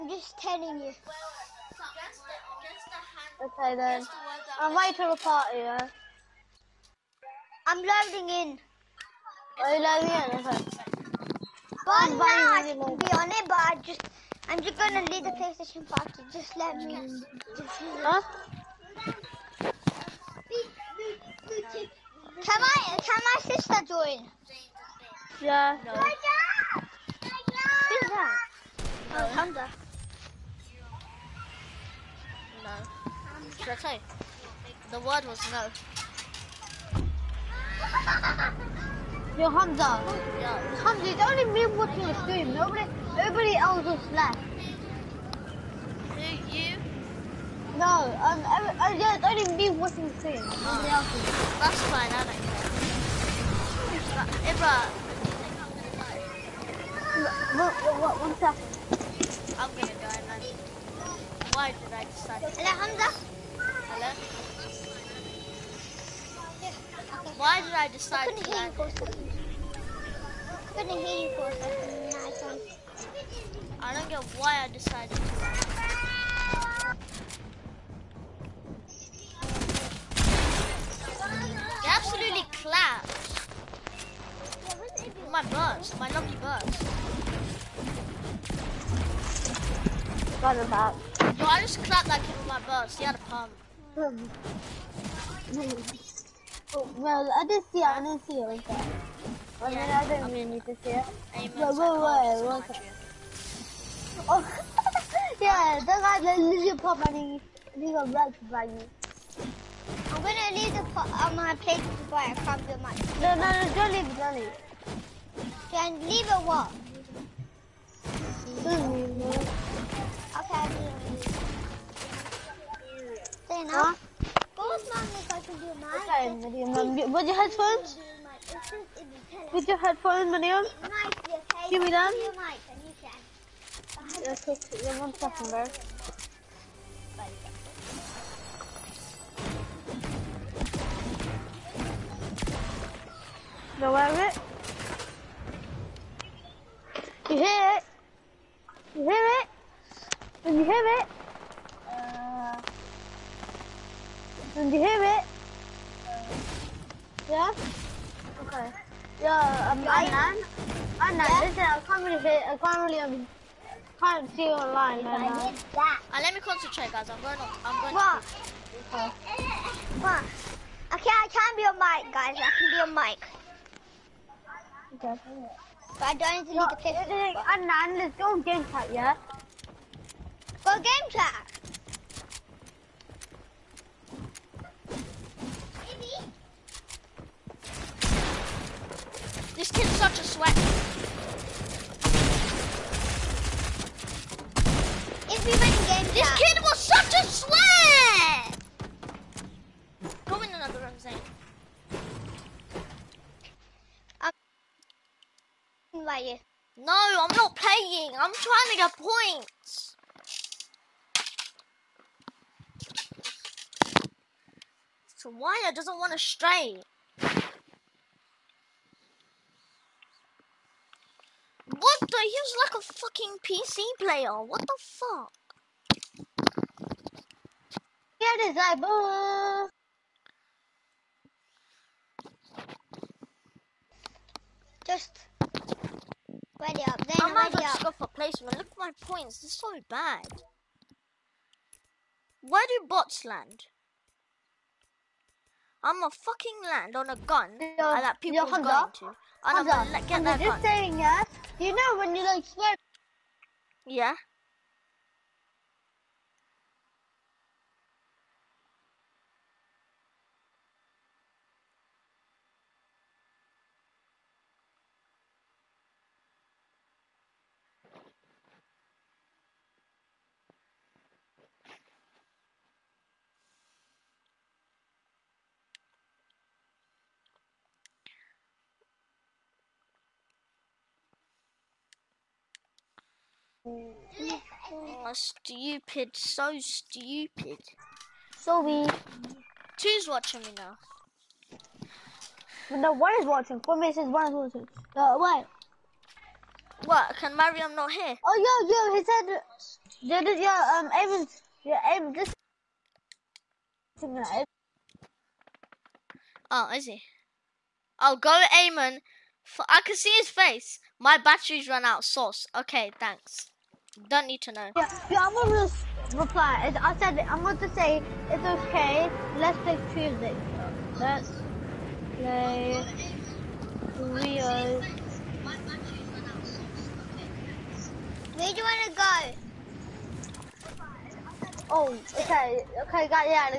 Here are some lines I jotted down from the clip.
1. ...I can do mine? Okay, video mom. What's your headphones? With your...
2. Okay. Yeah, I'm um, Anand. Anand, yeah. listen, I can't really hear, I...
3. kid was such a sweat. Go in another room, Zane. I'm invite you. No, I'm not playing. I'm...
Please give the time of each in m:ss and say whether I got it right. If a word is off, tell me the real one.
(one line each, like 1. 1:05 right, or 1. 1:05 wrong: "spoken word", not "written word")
1. 2:05 right
2. 2:38 right
3. 3:16 right.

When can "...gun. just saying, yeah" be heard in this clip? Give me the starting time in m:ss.
4:10.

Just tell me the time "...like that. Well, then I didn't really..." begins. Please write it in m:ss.
1:38.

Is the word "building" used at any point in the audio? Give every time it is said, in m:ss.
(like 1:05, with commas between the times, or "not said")
not said.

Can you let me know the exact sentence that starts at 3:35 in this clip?
So Wire doesn't want to stray.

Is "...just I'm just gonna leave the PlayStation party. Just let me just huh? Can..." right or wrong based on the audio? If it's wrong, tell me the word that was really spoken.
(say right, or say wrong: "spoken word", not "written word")
right.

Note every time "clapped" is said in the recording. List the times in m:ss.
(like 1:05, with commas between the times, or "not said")
1:22, 1:31.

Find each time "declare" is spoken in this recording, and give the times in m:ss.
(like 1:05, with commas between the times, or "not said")
not said.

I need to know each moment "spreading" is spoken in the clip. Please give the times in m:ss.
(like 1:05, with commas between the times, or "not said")
not said.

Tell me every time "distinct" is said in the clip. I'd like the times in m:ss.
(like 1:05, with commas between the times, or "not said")
not said.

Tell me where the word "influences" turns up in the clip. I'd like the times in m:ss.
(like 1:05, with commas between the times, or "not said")
not said.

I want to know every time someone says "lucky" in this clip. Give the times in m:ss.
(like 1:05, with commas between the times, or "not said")
1:26.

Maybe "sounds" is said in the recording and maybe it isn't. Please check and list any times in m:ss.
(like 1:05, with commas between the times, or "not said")
3:42.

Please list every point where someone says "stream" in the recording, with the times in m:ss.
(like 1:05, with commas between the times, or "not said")
0:42, 0:50.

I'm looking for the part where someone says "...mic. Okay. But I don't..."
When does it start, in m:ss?
2:52.